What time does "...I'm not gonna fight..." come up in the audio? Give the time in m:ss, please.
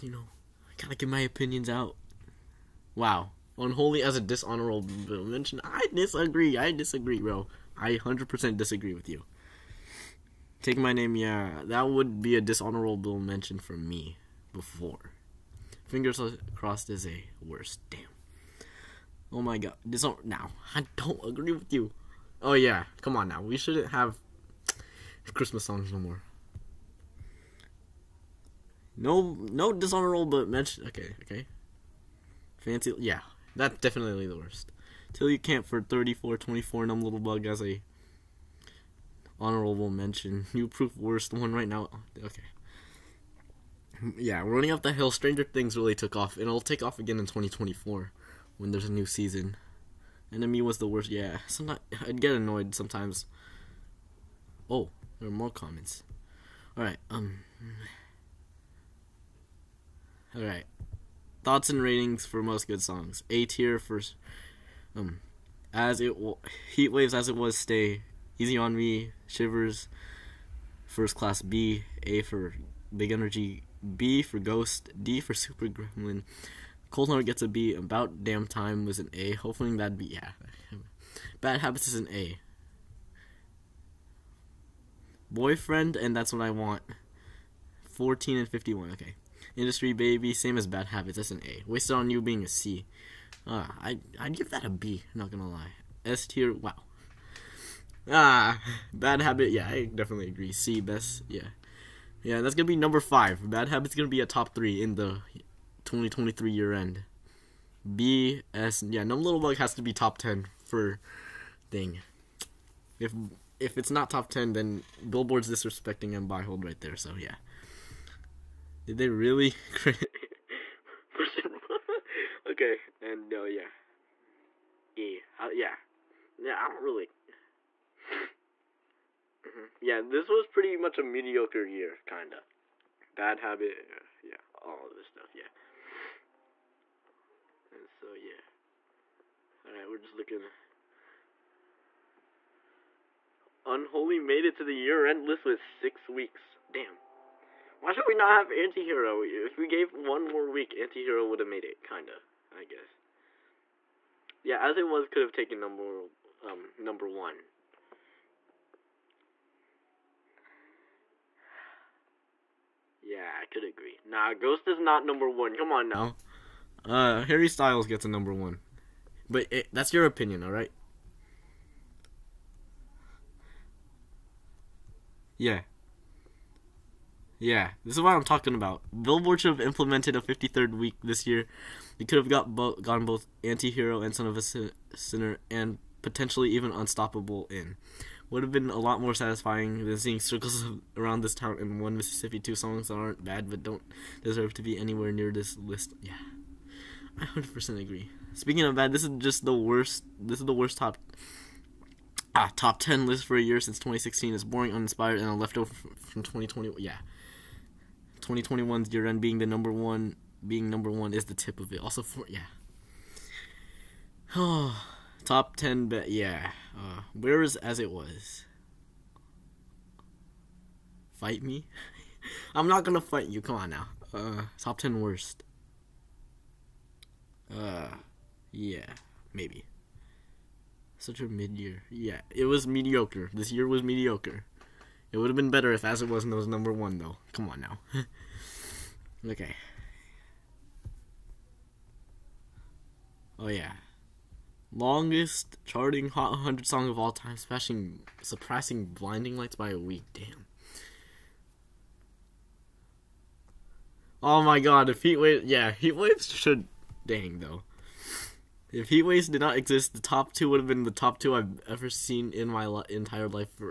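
3:42.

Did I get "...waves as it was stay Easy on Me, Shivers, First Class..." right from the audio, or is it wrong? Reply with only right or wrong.
right.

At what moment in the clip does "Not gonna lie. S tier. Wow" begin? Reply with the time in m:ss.
1:35.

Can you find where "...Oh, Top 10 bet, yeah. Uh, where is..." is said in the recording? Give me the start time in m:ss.
3:34.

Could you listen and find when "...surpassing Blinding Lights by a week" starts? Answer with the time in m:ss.
4:08.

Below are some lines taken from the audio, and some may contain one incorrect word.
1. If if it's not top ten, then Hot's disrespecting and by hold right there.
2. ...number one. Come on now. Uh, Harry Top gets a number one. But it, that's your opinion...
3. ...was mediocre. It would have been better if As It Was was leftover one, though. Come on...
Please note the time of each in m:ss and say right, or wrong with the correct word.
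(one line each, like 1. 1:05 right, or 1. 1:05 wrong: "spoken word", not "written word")
1. 1:52 wrong: "Billboard", not "Hot"
2. 2:45 wrong: "Styles", not "Top"
3. 3:53 wrong: "number", not "leftover".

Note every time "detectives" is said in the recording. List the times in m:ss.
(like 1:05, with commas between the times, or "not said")
not said.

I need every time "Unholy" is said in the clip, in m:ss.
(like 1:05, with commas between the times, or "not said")
0:03, 2:23.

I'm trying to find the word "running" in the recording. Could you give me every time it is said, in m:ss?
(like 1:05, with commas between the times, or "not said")
0:44.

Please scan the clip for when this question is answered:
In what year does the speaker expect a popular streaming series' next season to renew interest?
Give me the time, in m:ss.
0:47.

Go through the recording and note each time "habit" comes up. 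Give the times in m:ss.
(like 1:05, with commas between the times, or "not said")
1:21, 1:30, 1:39, 1:43, 2:13.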